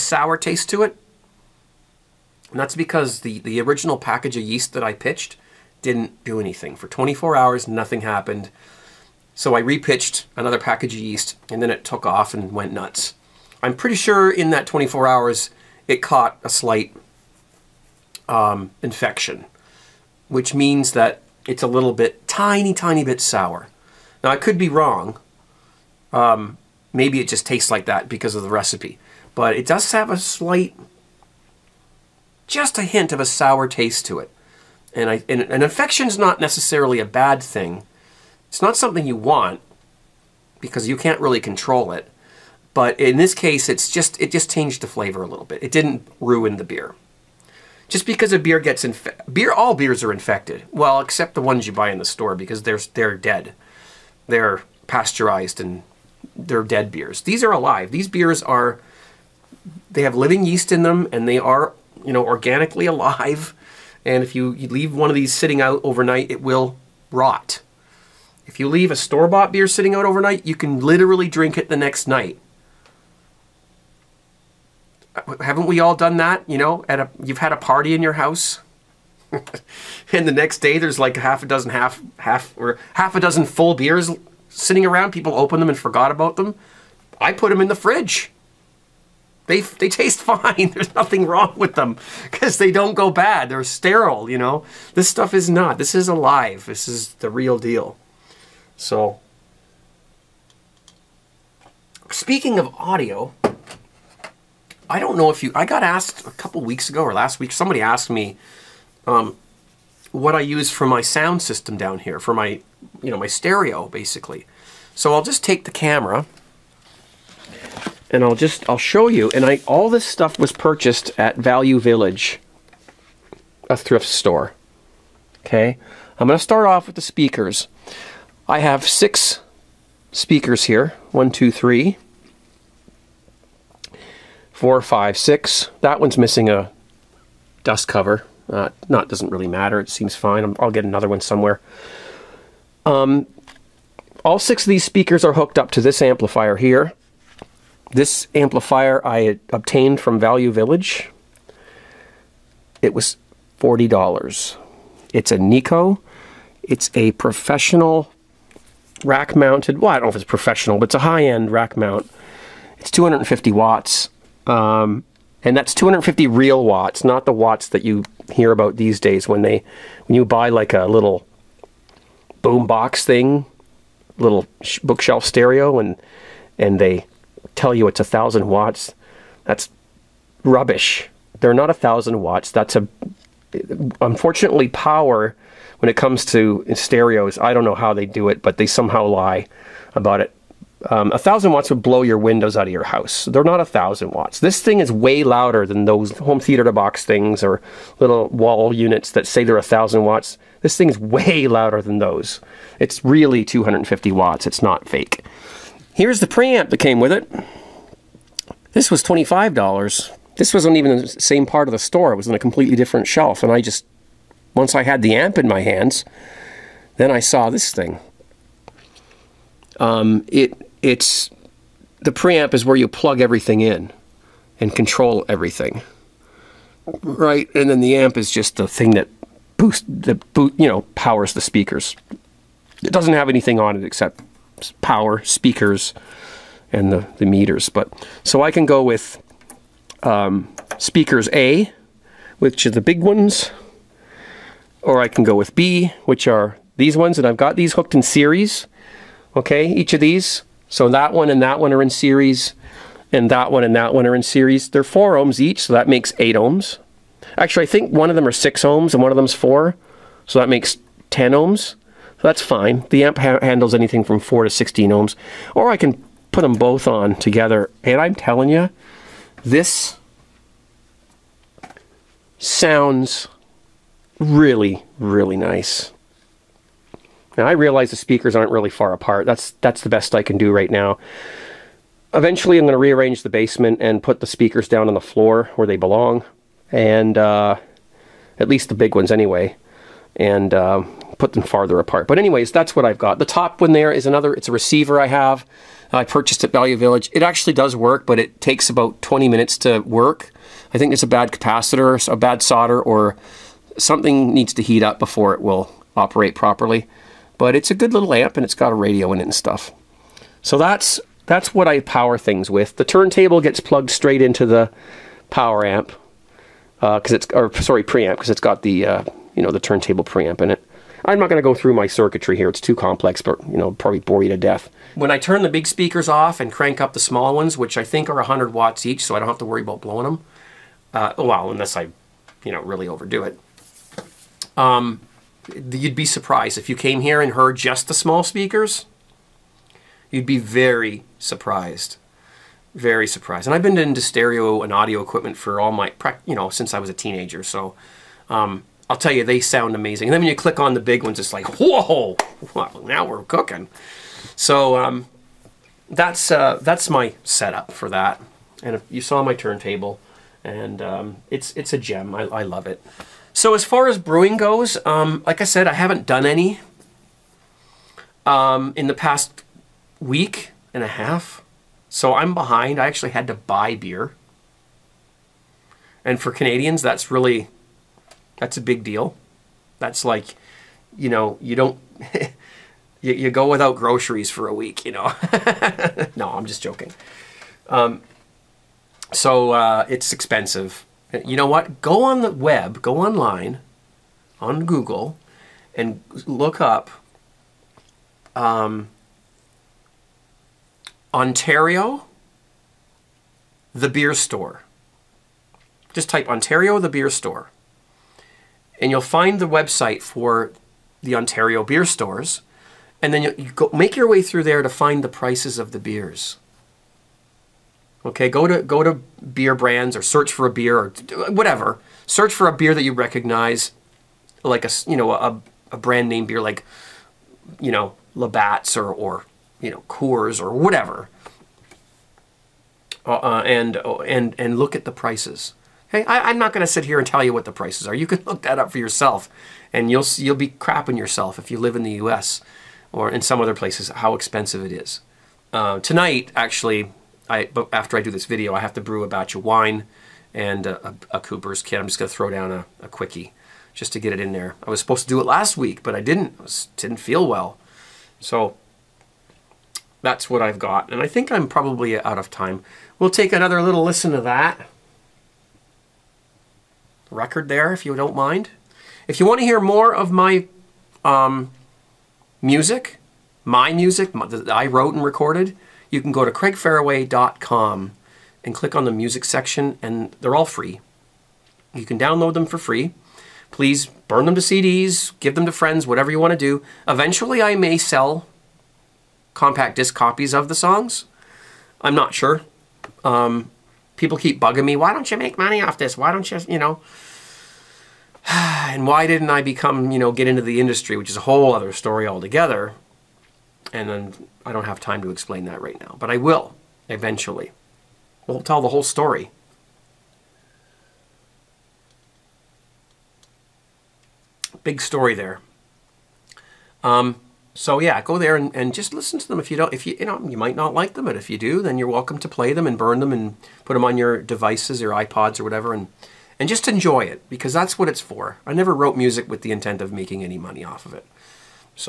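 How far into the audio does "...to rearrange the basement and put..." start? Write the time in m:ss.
4:42.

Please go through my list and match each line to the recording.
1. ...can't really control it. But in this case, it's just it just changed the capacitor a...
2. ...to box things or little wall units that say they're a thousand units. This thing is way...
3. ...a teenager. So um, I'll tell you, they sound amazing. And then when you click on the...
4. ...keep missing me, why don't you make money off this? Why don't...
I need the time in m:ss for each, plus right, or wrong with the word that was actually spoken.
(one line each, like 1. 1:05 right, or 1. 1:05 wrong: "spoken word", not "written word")
1. 0:40 wrong: "flavor", not "capacitor"
2. 3:16 wrong: "watts", not "units"
3. 5:46 right
4. 8:14 wrong: "bugging", not "missing".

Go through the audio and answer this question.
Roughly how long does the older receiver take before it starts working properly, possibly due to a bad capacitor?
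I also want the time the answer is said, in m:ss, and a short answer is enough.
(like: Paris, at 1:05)
20 minutes, at 4:59.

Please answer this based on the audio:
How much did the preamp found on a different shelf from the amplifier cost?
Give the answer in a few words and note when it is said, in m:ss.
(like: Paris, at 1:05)
$25, at 3:29.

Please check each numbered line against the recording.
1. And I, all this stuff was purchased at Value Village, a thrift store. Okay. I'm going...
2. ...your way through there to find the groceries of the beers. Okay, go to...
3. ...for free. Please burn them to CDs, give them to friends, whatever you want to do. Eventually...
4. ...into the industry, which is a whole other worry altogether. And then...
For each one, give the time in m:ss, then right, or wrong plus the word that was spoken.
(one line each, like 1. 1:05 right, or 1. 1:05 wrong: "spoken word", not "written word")
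1. 1:59 right
2. 6:53 wrong: "prices", not "groceries"
3. 8:02 right
4. 8:20 wrong: "story", not "worry".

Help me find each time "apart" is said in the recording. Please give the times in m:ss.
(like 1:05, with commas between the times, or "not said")
4:38, 4:51.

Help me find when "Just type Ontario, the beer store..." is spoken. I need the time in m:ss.
6:45.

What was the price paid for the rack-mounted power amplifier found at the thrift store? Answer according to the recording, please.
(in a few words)
$40.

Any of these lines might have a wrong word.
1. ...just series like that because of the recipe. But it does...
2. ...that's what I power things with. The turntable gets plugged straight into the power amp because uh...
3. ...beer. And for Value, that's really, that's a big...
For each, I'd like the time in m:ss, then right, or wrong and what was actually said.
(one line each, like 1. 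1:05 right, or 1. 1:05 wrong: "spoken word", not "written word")
1. 0:27 wrong: "tastes", not "series"
2. 5:11 right
3. 6:13 wrong: "Canadians", not "Value".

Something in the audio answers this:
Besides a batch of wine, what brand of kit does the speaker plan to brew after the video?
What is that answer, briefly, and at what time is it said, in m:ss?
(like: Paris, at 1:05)
Cooper's, at 7:31.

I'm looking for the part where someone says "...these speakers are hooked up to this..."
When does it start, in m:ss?
2:24.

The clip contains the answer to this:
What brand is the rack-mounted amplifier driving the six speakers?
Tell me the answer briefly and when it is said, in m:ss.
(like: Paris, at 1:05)
Nikko, at 2:35.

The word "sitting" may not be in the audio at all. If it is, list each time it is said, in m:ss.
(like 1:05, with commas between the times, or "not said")
1:05, 1:09, 1:24.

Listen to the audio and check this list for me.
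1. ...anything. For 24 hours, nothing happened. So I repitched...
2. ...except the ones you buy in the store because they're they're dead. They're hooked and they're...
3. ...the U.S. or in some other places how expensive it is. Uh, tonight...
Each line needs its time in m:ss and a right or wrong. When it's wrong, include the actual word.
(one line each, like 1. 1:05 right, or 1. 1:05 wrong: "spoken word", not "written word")
1. 0:06 right
2. 0:50 wrong: "pasteurized", not "hooked"
3. 7:21 right.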